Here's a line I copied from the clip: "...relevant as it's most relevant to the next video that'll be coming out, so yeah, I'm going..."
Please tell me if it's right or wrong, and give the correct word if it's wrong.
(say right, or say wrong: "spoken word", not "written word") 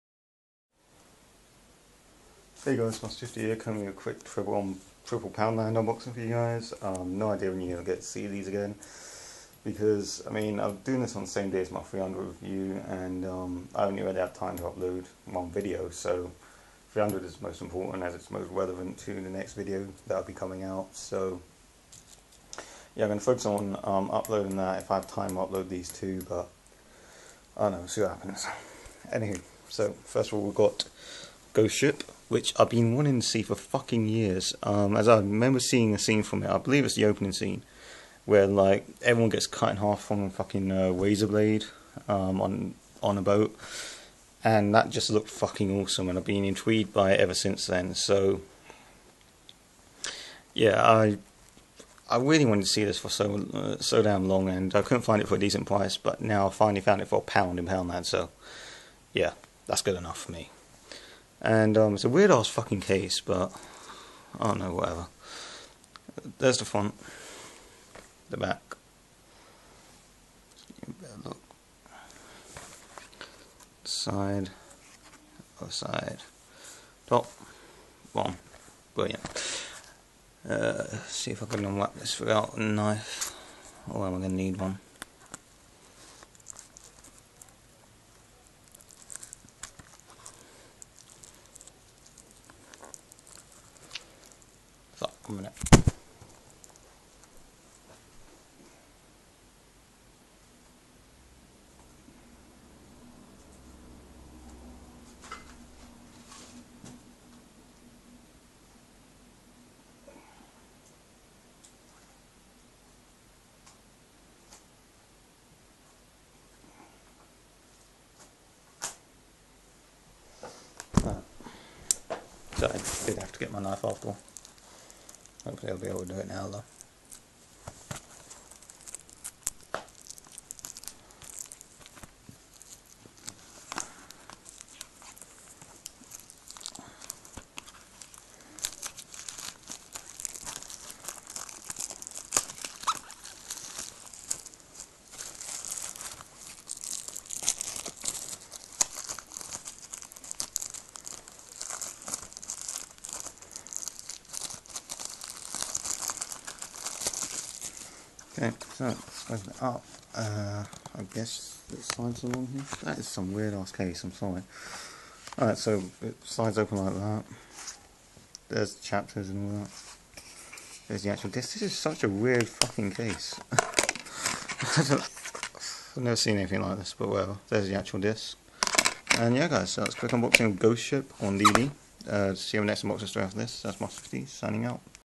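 wrong: "important", not "relevant".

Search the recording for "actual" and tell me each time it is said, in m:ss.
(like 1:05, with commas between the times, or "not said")
2:51, 2:57.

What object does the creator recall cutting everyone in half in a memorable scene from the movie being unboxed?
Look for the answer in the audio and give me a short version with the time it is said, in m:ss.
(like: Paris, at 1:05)
razor blade, at 0:40.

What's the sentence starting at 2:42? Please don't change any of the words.
That is some weird ass case, I'm sorry.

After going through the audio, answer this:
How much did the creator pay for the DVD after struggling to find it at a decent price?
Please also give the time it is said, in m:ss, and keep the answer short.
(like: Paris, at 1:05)
a pound, at 0:57.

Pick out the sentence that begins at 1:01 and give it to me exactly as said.
And um, it's a weird ass fucking case, but I don't know, whatever.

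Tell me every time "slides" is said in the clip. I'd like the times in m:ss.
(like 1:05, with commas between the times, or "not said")
2:41, 2:46.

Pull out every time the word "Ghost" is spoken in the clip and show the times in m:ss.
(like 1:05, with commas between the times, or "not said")
0:31, 3:00.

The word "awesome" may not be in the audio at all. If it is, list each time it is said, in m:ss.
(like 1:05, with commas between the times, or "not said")
0:45.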